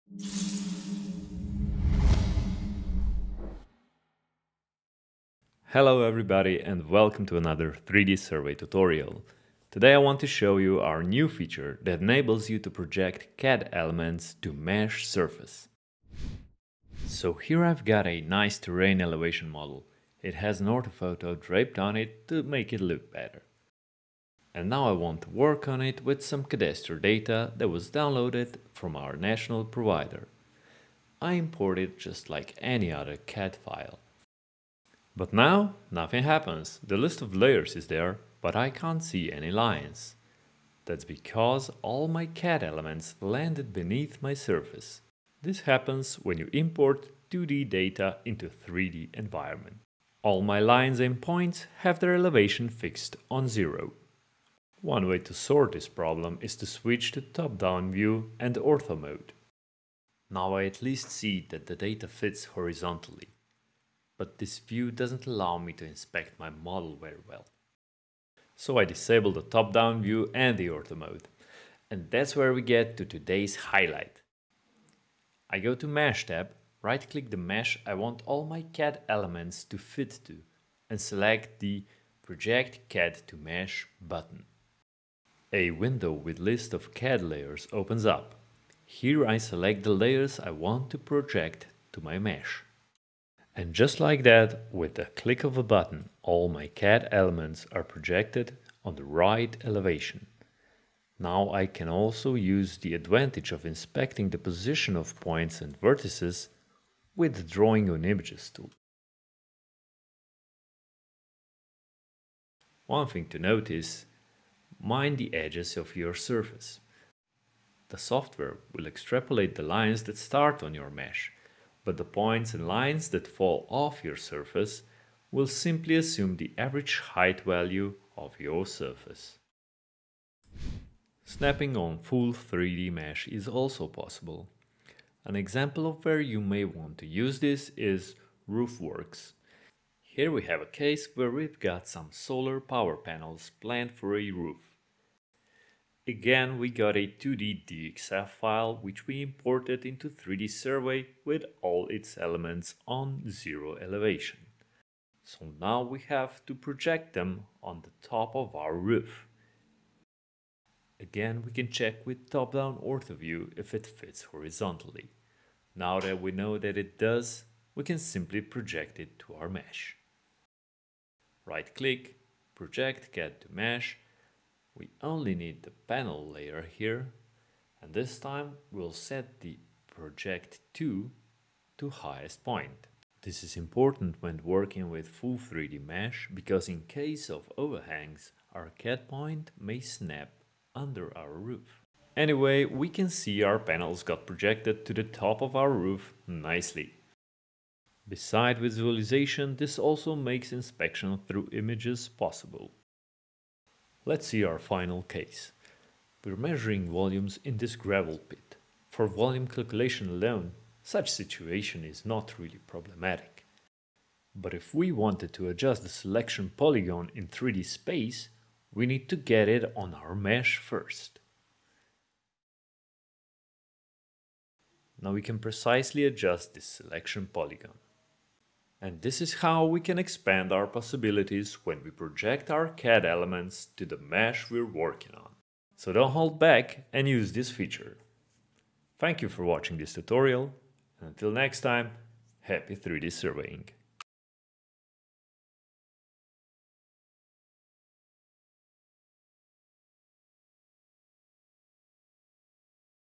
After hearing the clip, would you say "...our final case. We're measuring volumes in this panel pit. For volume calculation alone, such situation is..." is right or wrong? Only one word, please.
wrong.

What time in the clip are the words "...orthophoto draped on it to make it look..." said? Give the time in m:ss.
0:20.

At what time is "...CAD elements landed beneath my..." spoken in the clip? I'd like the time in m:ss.
0:42.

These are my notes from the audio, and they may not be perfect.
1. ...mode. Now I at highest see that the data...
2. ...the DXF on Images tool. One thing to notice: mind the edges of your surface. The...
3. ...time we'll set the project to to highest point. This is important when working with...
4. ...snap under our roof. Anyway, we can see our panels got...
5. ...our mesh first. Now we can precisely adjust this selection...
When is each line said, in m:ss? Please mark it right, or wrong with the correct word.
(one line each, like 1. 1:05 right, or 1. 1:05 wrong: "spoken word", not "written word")
1. 0:58 wrong: "least", not "highest"
2. 1:47 wrong: "Drawing", not "DXF"
3. 2:58 right
4. 3:09 right
5. 3:39 right.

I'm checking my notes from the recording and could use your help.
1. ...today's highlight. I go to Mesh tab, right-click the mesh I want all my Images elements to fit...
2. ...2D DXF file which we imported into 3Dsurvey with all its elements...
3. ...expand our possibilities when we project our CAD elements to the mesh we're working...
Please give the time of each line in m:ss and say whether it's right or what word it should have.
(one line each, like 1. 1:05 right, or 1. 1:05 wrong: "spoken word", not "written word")
1. 1:13 wrong: "CAD", not "Images"
2. 2:27 right
3. 3:49 right.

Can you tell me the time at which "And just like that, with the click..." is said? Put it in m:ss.
1:33.